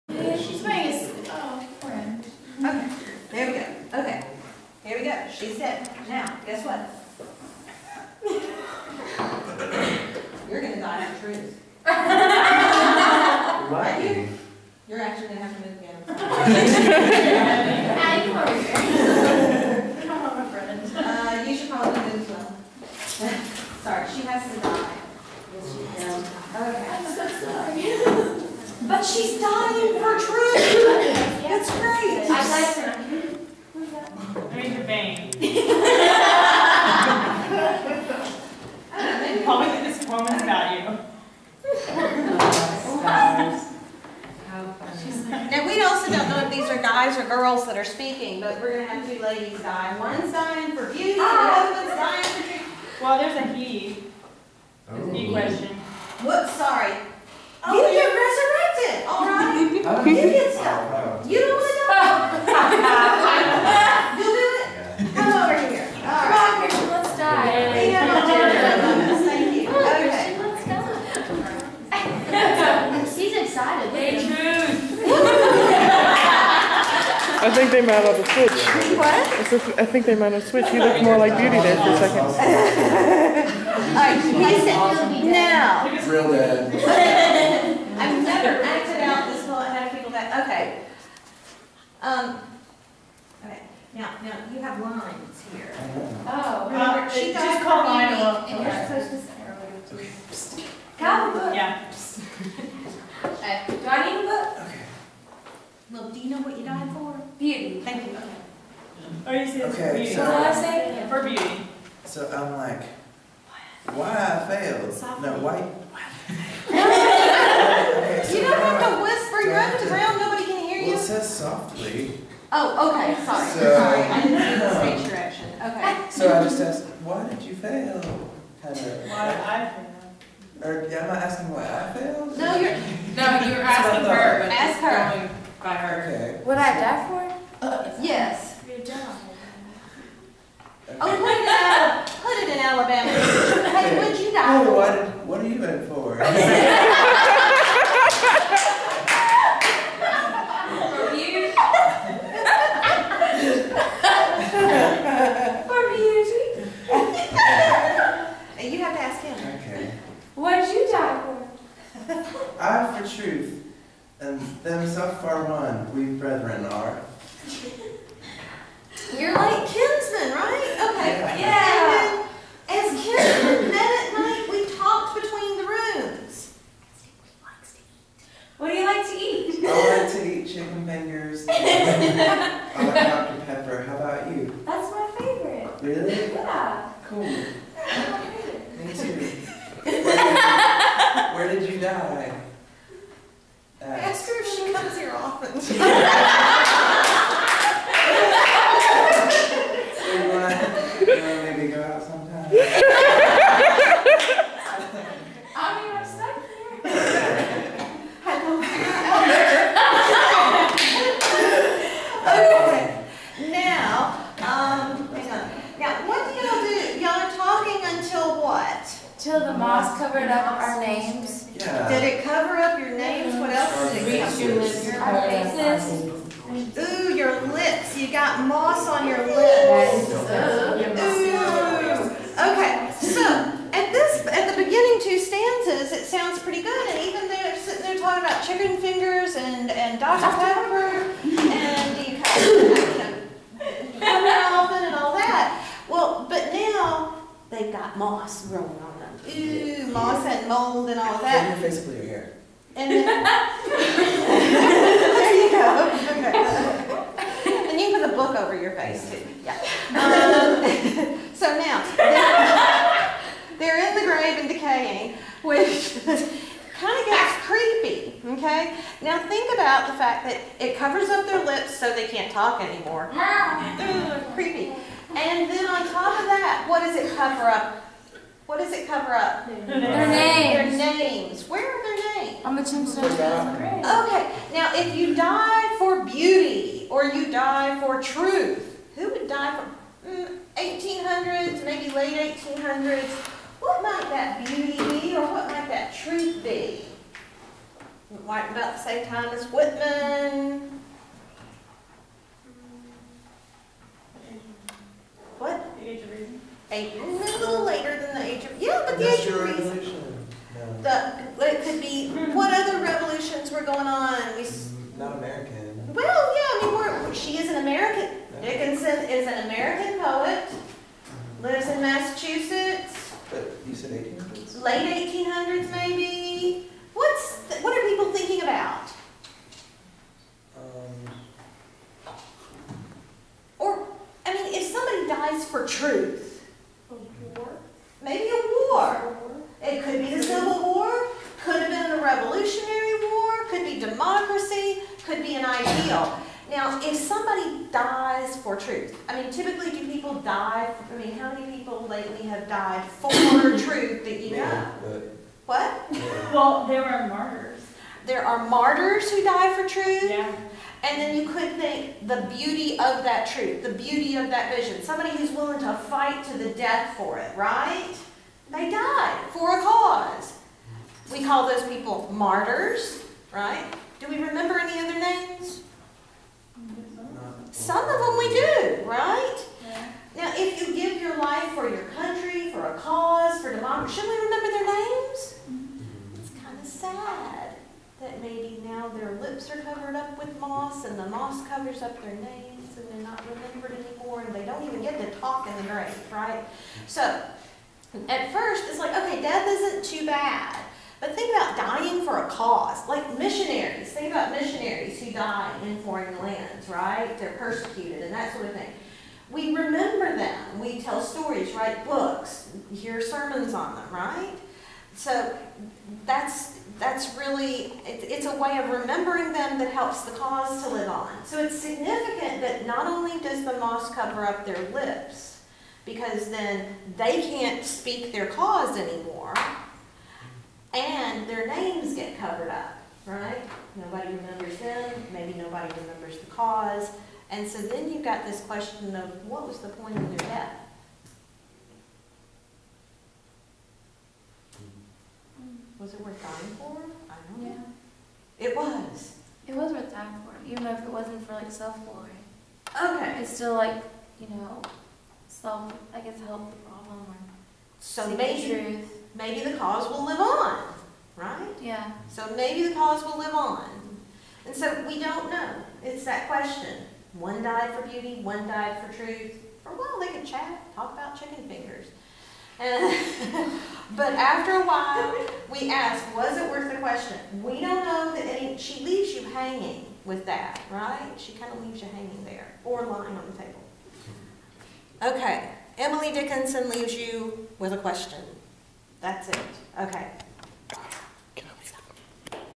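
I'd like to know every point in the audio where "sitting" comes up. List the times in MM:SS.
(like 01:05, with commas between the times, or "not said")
03:57.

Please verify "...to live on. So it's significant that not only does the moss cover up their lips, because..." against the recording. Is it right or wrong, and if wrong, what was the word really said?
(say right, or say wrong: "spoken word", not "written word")
right.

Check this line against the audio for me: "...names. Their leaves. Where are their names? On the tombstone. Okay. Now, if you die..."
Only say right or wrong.
wrong.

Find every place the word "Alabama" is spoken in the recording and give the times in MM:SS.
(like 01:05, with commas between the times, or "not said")
02:22.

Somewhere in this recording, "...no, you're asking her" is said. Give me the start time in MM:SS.
02:12.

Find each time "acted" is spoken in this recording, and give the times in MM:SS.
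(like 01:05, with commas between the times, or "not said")
01:28.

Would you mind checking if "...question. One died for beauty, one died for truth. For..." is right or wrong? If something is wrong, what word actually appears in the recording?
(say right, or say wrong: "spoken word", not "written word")
right.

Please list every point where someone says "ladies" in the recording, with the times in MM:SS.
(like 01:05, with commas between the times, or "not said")
00:49.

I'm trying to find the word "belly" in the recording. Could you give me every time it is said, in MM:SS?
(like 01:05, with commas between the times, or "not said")
not said.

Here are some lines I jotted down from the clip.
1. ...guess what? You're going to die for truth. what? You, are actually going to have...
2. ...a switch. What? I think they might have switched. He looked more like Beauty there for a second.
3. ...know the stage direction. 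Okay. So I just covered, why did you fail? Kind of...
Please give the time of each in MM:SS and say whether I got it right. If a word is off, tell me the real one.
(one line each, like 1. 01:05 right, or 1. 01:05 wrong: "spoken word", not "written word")
1. 00:06 right
2. 01:18 right
3. 02:04 wrong: "asked", not "covered".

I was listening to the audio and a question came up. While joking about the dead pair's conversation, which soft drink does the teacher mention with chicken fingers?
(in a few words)
Dr. Pepper.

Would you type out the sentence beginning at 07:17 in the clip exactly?
And so then you've got this question of what was the point of their death?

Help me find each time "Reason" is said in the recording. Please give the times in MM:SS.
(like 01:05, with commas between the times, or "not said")
05:06.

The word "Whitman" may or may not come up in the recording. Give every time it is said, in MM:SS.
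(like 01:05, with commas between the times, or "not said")
04:59.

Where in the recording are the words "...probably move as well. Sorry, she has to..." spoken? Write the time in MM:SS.
00:21.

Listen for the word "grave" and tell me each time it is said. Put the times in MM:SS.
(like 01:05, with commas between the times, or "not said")
04:24, 06:35.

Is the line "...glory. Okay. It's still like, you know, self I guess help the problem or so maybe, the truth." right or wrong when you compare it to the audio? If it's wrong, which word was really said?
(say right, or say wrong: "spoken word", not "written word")
right.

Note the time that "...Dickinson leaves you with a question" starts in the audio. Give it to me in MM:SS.
08:06.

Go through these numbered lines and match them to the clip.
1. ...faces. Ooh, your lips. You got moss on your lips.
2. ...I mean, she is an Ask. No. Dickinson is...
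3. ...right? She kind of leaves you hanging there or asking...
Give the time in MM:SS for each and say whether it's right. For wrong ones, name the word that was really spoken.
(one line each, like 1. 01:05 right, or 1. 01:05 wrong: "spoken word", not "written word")
1. 03:45 right
2. 05:16 wrong: "American", not "Ask"
3. 08:00 wrong: "lying", not "asking".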